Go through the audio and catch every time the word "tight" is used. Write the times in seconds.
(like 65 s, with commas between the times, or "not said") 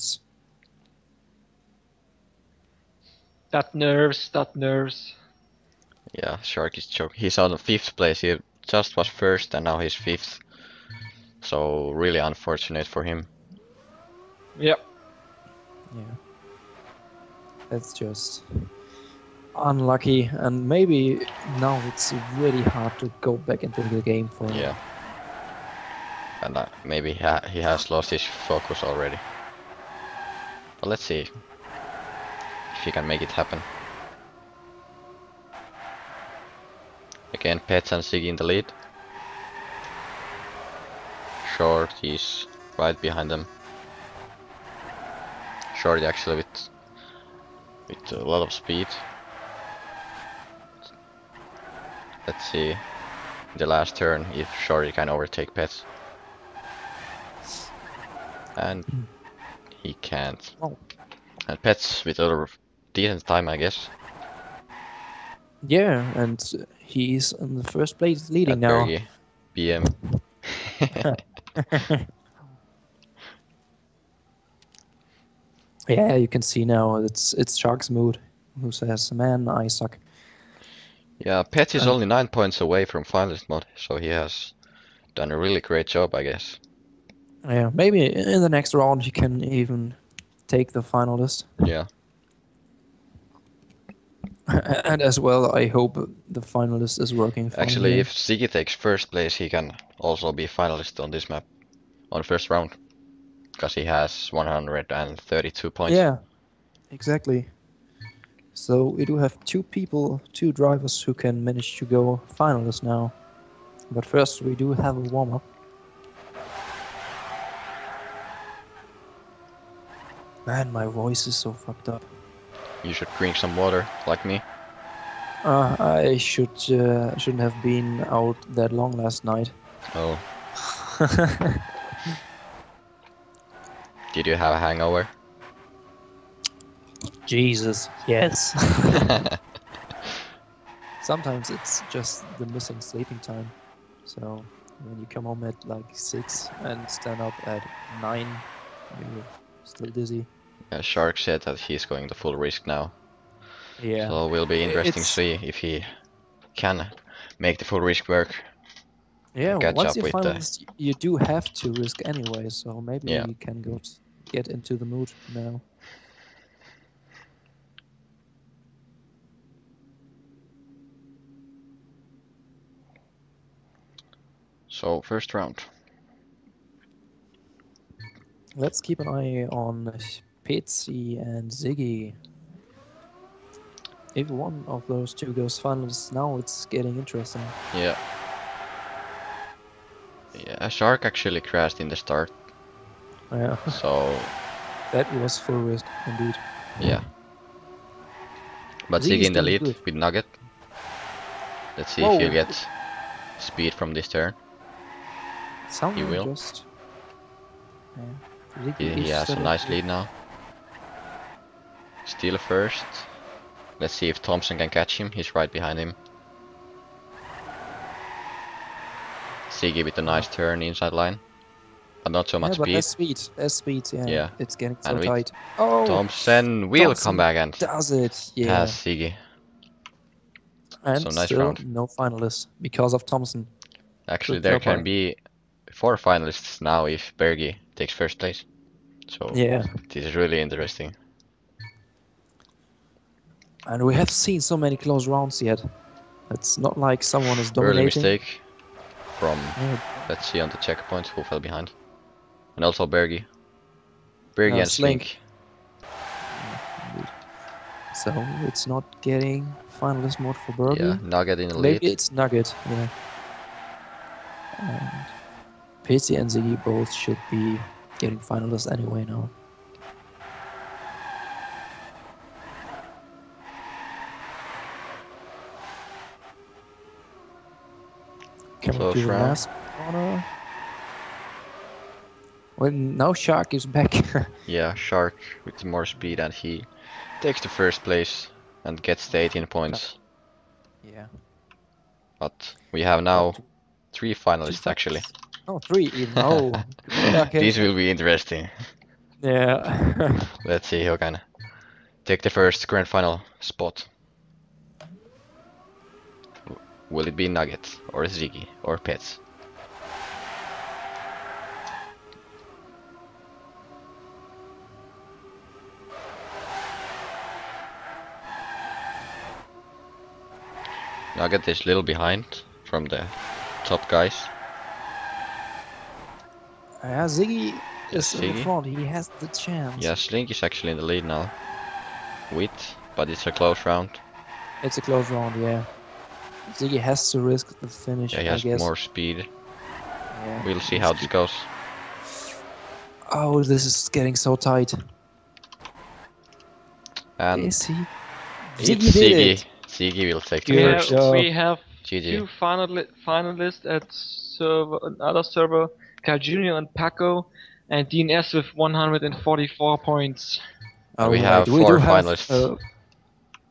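225 s, 344 s.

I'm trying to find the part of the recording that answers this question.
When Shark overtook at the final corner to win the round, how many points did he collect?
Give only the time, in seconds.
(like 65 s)
289 s.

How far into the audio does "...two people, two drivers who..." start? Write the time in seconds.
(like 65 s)
109 s.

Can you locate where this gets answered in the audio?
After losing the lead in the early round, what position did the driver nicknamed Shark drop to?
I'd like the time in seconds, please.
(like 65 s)
7 s.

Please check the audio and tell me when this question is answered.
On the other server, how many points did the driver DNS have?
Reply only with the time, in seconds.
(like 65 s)
358 s.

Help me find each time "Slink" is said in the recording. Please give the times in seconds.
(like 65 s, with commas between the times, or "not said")
254 s, 329 s.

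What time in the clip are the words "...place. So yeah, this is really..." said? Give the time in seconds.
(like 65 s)
238 s.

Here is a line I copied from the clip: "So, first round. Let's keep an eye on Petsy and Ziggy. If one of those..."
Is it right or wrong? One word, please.
right.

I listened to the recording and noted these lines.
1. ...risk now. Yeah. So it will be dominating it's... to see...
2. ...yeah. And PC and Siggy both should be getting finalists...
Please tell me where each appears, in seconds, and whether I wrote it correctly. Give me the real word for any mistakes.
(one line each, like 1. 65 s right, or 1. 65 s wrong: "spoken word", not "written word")
1. 152 s wrong: "interesting", not "dominating"
2. 262 s wrong: "Ziggy", not "Siggy".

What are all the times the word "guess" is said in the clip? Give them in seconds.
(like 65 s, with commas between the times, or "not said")
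63 s, 86 s, 338 s.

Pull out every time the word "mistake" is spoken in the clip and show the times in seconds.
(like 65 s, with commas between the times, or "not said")
247 s.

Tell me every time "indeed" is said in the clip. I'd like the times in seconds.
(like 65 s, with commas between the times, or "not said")
196 s.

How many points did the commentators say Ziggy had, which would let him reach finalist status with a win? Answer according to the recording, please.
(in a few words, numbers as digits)
132.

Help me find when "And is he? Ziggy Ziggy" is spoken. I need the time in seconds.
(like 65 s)
347 s.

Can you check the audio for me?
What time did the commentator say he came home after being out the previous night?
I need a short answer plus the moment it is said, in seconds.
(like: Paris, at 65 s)
6, at 145 s.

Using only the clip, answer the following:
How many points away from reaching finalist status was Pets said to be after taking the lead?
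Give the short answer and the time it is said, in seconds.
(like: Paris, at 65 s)
9, at 82 s.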